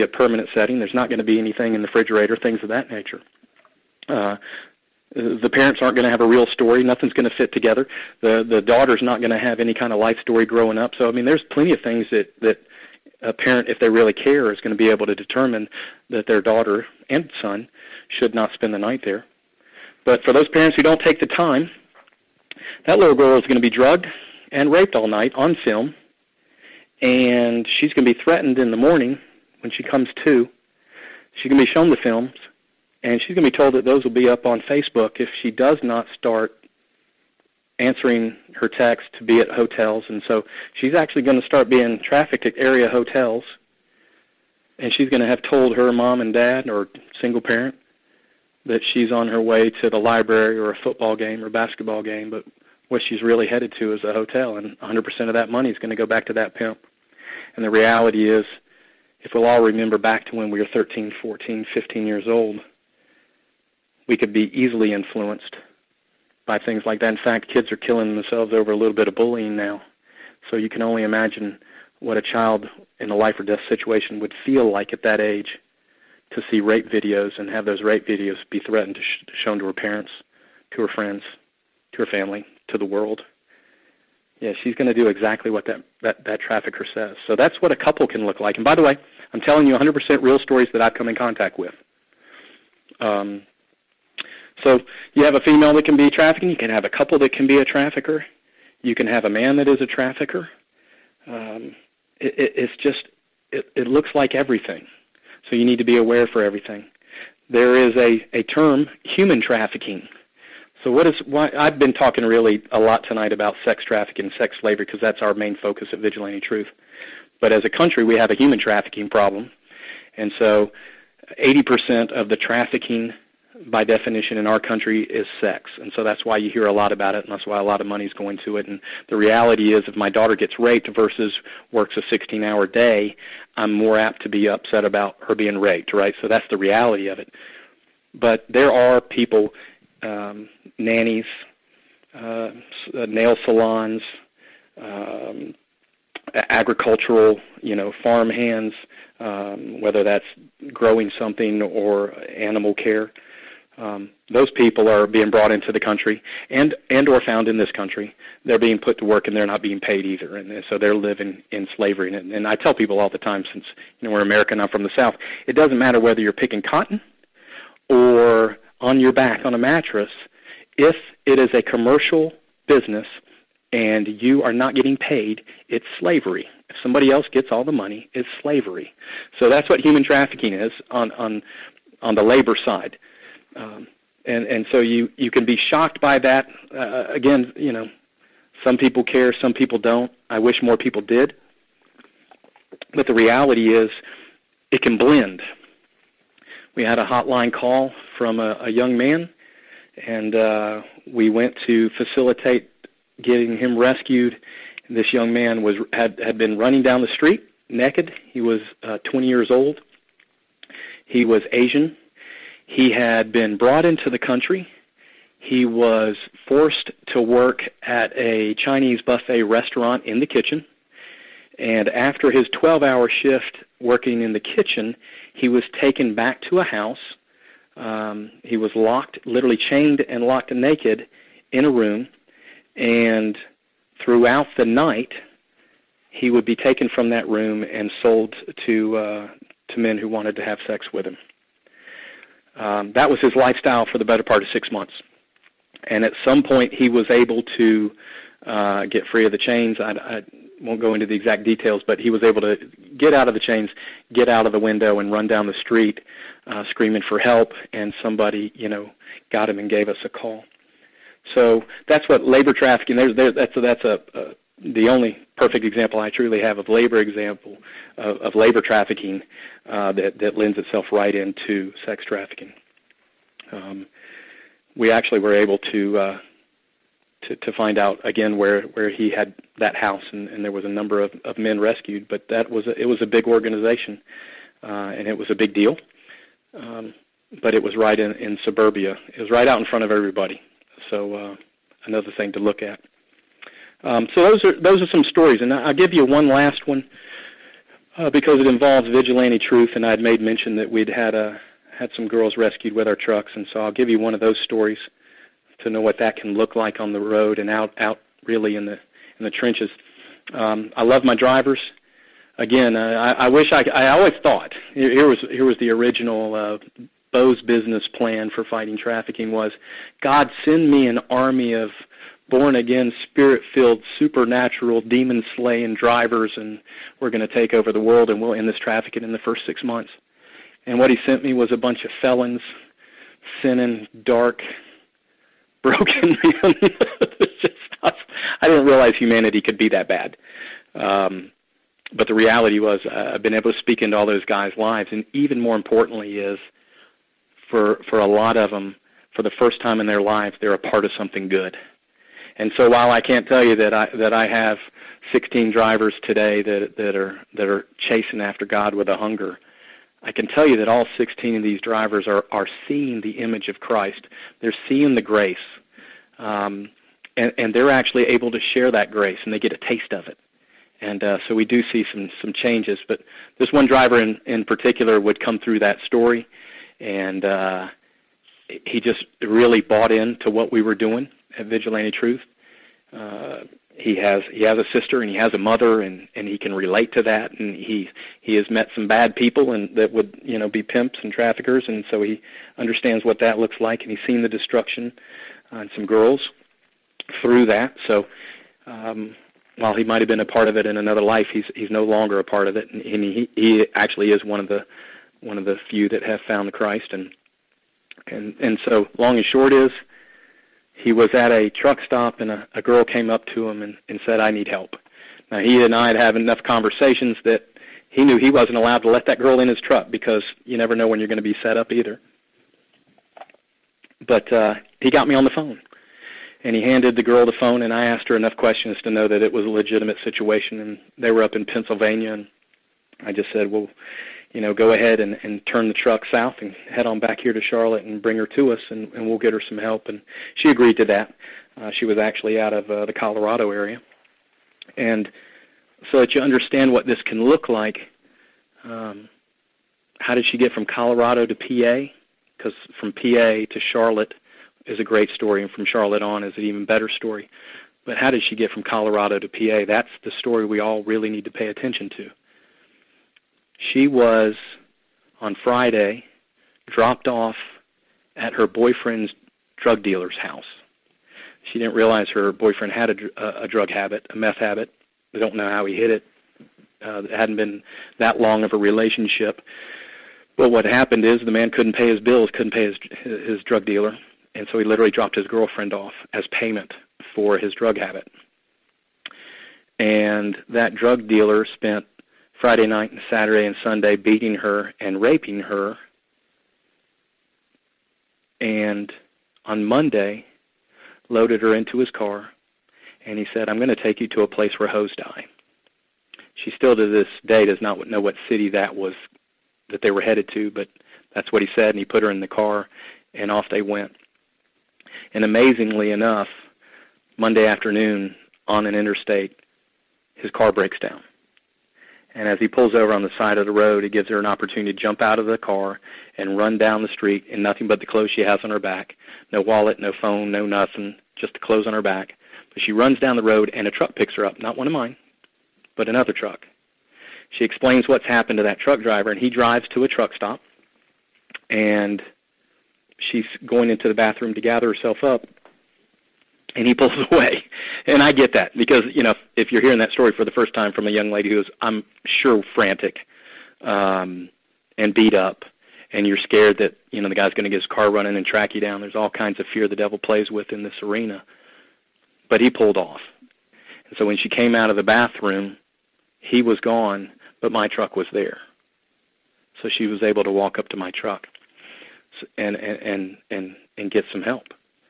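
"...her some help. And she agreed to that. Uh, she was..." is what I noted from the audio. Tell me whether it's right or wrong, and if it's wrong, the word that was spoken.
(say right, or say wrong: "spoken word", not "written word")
right.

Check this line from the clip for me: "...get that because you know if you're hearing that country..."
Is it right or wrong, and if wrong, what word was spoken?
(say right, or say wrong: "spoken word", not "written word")
wrong: "story", not "country".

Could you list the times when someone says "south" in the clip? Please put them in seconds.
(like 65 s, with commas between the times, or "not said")
164 s, 436 s.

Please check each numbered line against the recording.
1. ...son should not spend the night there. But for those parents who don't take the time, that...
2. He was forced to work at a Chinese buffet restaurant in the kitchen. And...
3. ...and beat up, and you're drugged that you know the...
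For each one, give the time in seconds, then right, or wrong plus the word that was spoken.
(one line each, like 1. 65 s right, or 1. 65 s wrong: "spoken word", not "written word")
1. 17 s right
2. 215 s right
3. 554 s wrong: "scared", not "drugged".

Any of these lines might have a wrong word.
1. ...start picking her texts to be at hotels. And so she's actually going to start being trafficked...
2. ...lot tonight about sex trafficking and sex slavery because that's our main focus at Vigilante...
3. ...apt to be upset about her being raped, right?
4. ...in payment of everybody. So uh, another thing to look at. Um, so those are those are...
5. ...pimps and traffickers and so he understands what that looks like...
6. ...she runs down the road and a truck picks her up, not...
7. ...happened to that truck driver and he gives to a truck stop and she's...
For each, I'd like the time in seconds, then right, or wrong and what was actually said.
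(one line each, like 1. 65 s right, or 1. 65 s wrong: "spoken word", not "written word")
1. 36 s wrong: "answering", not "picking"
2. 112 s right
3. 133 s right
4. 289 s wrong: "front", not "payment"
5. 390 s right
6. 532 s right
7. 538 s wrong: "drives", not "gives".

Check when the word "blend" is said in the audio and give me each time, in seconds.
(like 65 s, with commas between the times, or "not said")
194 s.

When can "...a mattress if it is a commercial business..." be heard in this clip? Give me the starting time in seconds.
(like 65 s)
169 s.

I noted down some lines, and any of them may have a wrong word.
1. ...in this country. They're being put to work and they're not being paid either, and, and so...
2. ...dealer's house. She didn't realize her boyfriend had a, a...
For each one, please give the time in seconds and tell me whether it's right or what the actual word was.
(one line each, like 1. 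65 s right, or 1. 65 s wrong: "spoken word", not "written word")
1. 157 s right
2. 469 s right.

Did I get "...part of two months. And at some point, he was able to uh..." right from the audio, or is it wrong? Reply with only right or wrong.
wrong.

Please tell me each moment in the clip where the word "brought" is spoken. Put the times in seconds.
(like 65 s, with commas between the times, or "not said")
155 s, 213 s.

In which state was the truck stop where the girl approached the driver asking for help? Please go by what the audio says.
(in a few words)
Pennsylvania.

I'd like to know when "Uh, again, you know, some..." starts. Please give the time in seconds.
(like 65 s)
186 s.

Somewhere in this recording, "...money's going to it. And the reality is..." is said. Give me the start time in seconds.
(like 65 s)
127 s.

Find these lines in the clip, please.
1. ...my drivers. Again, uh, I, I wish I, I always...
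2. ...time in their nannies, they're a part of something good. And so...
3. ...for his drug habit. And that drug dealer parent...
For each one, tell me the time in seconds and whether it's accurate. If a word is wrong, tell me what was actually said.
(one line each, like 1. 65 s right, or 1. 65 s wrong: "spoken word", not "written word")
1. 311 s right
2. 349 s wrong: "lives", not "nannies"
3. 487 s wrong: "spent", not "parent".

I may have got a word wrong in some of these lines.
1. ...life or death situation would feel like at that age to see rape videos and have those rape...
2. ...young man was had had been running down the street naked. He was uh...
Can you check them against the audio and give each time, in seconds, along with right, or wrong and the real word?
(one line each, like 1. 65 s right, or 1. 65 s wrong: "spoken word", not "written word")
1. 73 s right
2. 205 s right.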